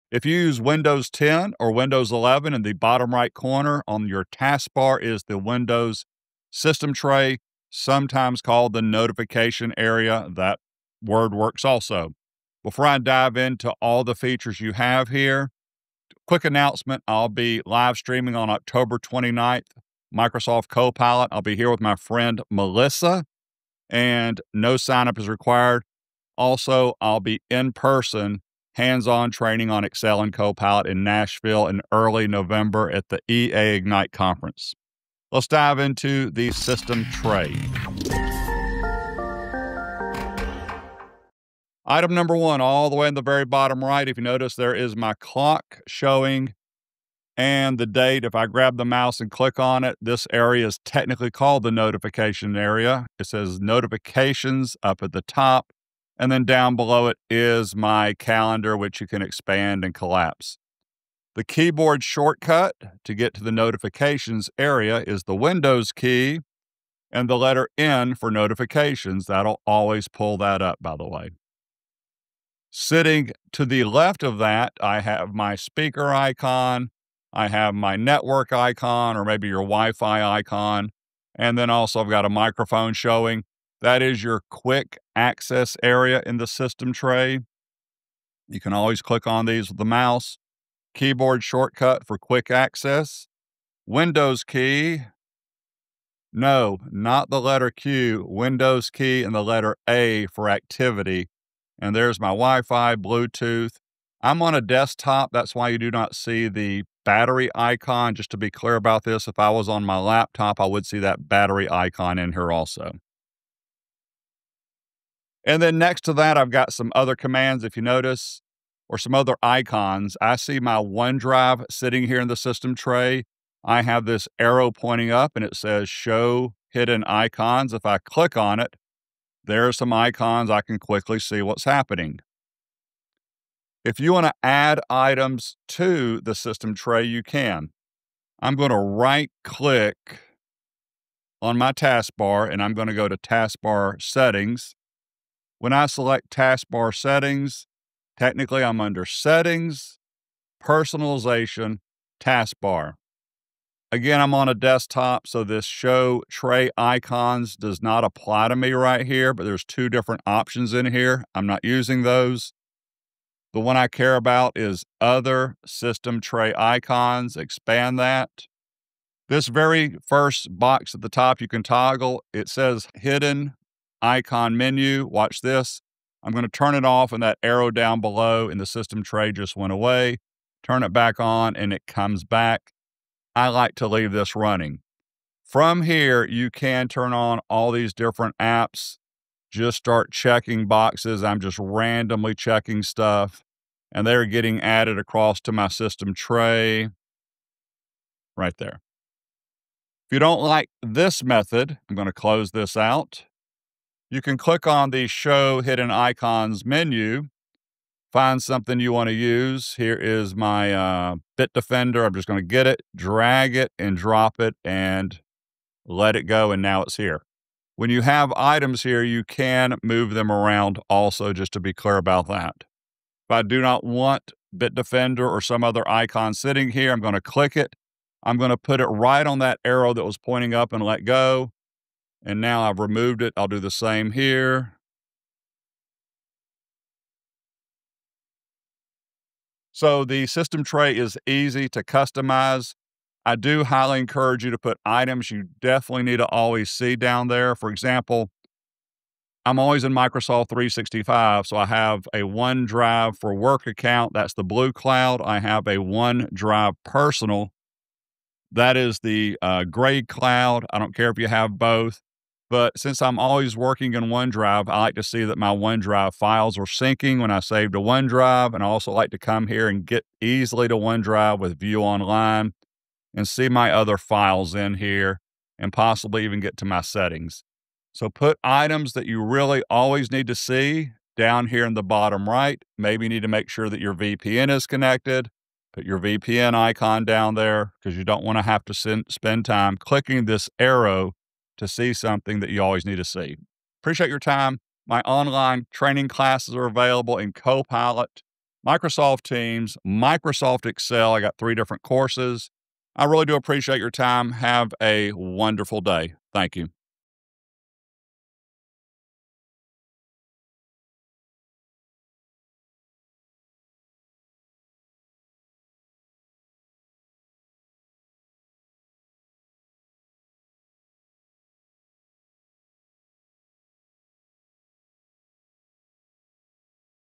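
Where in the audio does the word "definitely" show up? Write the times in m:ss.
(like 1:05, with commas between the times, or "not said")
4:05.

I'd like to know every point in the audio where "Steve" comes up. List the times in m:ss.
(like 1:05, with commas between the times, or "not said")
not said.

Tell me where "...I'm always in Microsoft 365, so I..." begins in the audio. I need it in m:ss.
4:09.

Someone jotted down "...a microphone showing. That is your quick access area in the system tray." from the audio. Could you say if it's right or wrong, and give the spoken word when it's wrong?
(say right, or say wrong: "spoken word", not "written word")
right.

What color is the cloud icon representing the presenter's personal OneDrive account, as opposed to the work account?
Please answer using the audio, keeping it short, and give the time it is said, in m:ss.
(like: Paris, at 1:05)
Gray, at 4:19.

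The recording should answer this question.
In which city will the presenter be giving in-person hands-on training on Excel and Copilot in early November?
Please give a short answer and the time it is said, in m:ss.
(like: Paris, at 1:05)
Nashville, at 0:31.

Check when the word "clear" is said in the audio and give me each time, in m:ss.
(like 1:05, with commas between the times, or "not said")
1:48, 3:41.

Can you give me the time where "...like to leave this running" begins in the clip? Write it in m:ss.
3:03.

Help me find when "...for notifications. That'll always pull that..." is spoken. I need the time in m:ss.
1:08.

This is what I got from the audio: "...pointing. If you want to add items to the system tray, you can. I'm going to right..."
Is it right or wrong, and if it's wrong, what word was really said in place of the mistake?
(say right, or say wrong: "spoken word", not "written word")
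wrong: "happening", not "pointing".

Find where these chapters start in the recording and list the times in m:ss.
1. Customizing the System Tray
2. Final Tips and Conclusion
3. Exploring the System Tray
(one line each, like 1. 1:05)
1. 2:13
2. 4:03
3. 0:35.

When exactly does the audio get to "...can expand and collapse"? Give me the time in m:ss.
0:59.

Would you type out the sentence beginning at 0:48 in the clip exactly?
If I grab the mouse and click on it, this area is technically called the notification area.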